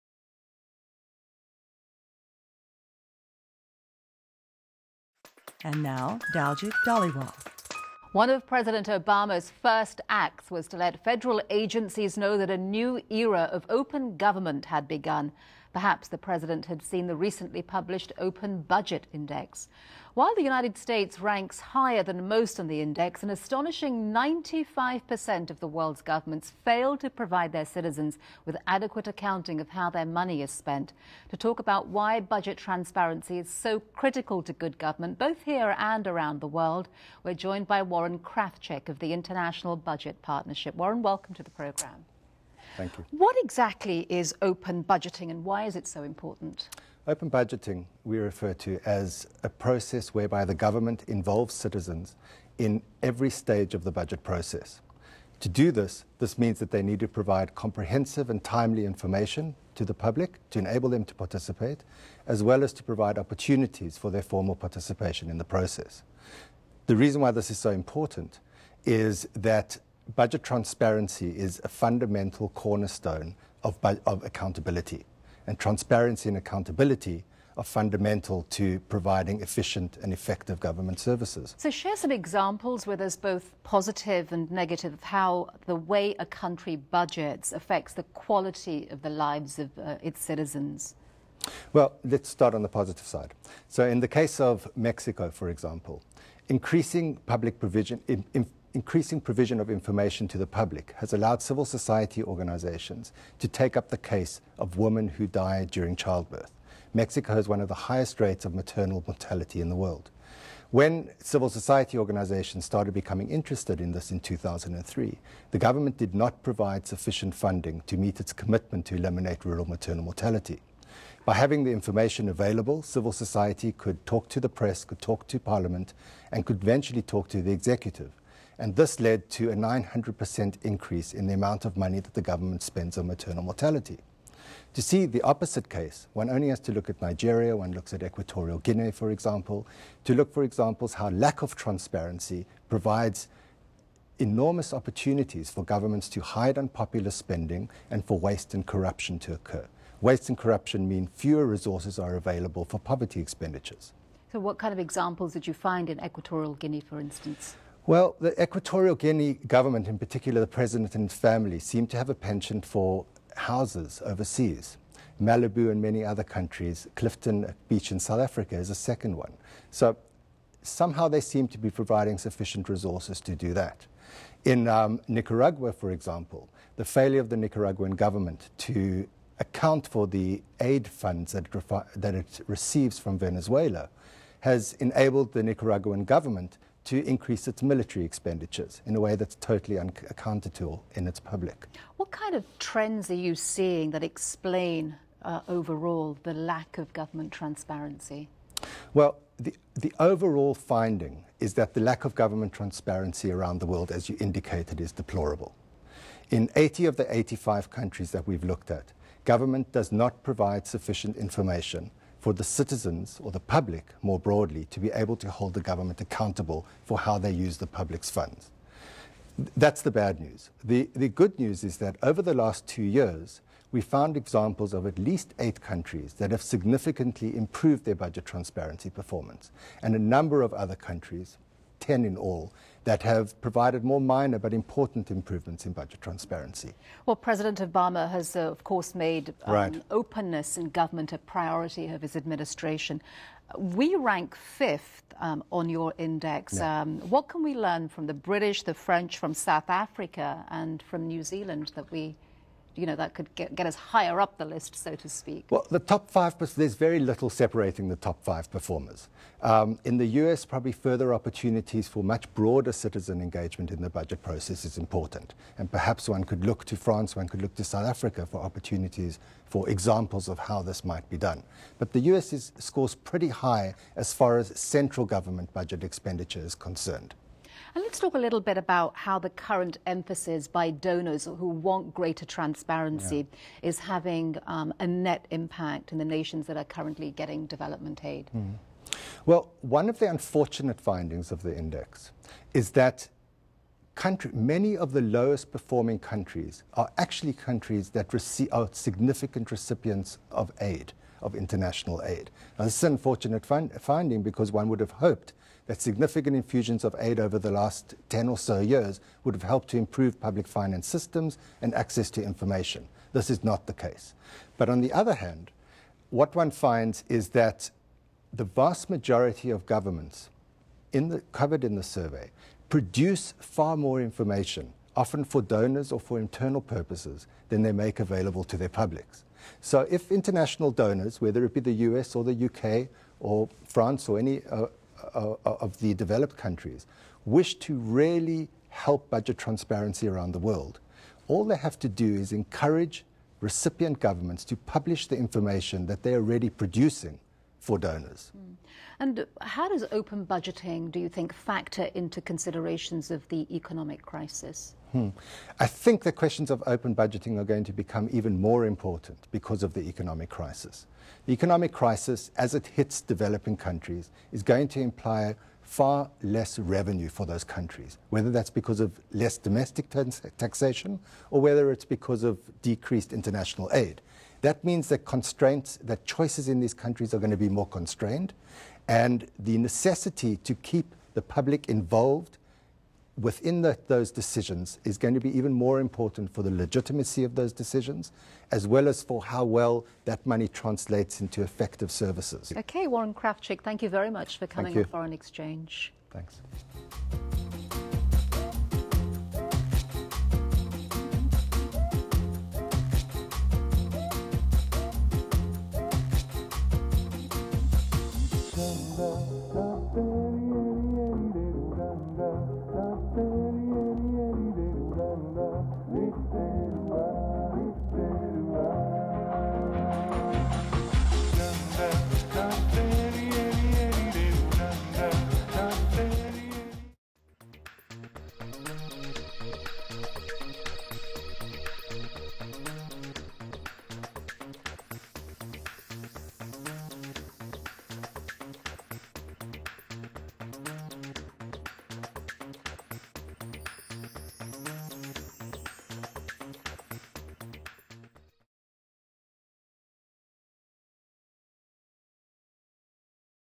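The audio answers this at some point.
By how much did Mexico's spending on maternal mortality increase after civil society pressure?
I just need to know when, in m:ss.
2:09.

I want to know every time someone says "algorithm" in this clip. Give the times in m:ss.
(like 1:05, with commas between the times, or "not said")
not said.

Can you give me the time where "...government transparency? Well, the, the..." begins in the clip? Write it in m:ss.
3:16.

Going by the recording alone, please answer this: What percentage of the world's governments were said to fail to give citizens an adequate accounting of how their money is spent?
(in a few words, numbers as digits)
95%.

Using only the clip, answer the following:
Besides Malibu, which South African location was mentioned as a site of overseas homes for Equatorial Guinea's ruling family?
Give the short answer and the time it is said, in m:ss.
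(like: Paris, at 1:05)
Clifton Beach, at 2:46.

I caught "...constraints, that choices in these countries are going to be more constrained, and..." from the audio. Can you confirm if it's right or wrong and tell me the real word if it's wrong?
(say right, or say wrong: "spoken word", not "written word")
right.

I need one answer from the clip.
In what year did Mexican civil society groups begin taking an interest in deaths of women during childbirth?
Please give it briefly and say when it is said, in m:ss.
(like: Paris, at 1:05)
2003, at 1:54.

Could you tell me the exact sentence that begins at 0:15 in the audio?
Perhaps the president had seen the recently published Open Budget Index.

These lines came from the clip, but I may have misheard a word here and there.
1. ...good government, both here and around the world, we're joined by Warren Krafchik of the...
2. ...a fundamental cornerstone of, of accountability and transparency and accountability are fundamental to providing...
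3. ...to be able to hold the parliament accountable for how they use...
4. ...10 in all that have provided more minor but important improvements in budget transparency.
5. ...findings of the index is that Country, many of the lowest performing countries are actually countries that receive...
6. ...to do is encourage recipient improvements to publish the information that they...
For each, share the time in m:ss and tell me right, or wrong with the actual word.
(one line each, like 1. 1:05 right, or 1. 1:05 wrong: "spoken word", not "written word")
1. 0:34 right
2. 1:11 right
3. 3:34 wrong: "government", not "parliament"
4. 3:51 right
5. 4:50 right
6. 5:41 wrong: "governments", not "improvements".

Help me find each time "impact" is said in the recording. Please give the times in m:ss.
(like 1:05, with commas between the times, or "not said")
4:45.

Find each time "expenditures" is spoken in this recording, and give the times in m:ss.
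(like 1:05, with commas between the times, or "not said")
2:33, 3:08, 4:35.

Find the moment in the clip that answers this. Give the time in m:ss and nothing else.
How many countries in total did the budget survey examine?
3:27.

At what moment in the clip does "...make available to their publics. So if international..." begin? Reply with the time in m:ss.
5:27.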